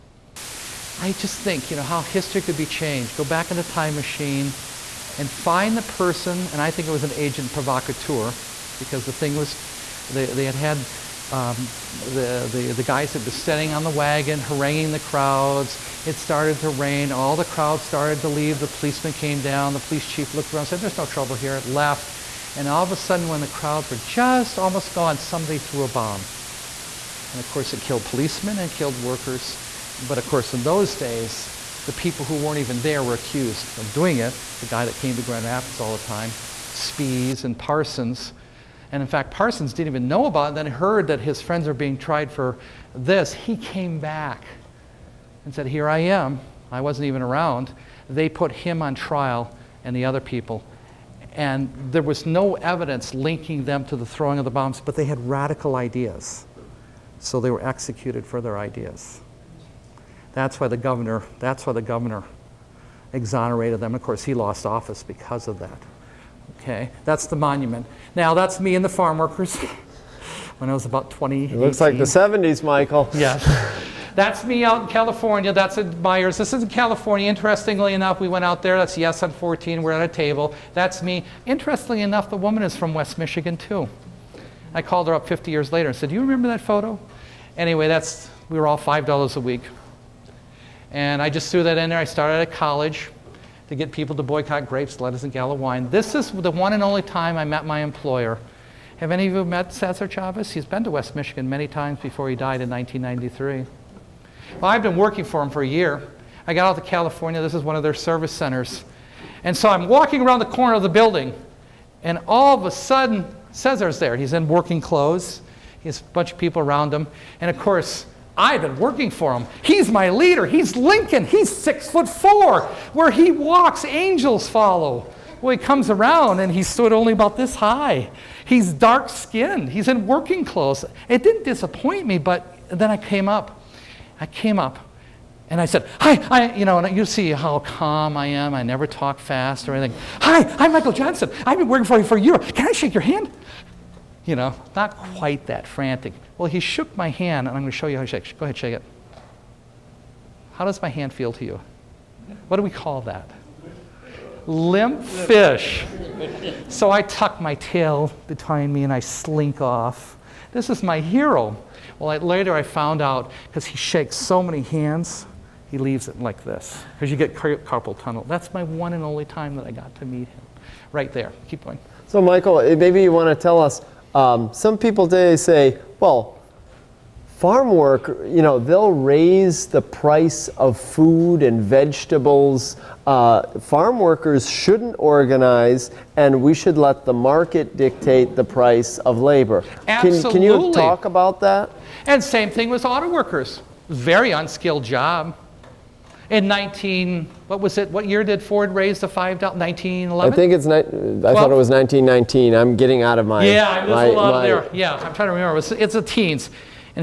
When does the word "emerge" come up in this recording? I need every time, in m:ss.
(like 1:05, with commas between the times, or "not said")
not said.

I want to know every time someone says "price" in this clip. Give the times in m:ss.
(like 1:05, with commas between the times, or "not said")
2:59, 3:08.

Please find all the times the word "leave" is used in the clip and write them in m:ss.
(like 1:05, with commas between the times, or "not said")
0:18, 2:45.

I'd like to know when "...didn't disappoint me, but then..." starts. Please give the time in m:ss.
2:11.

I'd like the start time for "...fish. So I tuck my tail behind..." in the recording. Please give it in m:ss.
2:35.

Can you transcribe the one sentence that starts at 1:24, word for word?
I called her up 50 years later and said, Do you remember that photo?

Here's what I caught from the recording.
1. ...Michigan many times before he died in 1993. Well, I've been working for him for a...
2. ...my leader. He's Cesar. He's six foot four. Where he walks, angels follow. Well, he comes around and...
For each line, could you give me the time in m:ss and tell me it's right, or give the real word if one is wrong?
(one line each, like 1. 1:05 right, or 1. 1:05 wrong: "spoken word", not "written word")
1. 1:41 right
2. 1:59 wrong: "Lincoln", not "Cesar".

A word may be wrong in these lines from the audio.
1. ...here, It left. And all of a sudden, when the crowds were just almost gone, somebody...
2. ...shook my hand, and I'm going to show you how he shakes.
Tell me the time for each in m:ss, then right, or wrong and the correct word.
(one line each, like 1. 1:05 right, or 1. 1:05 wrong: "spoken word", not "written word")
1. 0:21 right
2. 2:26 right.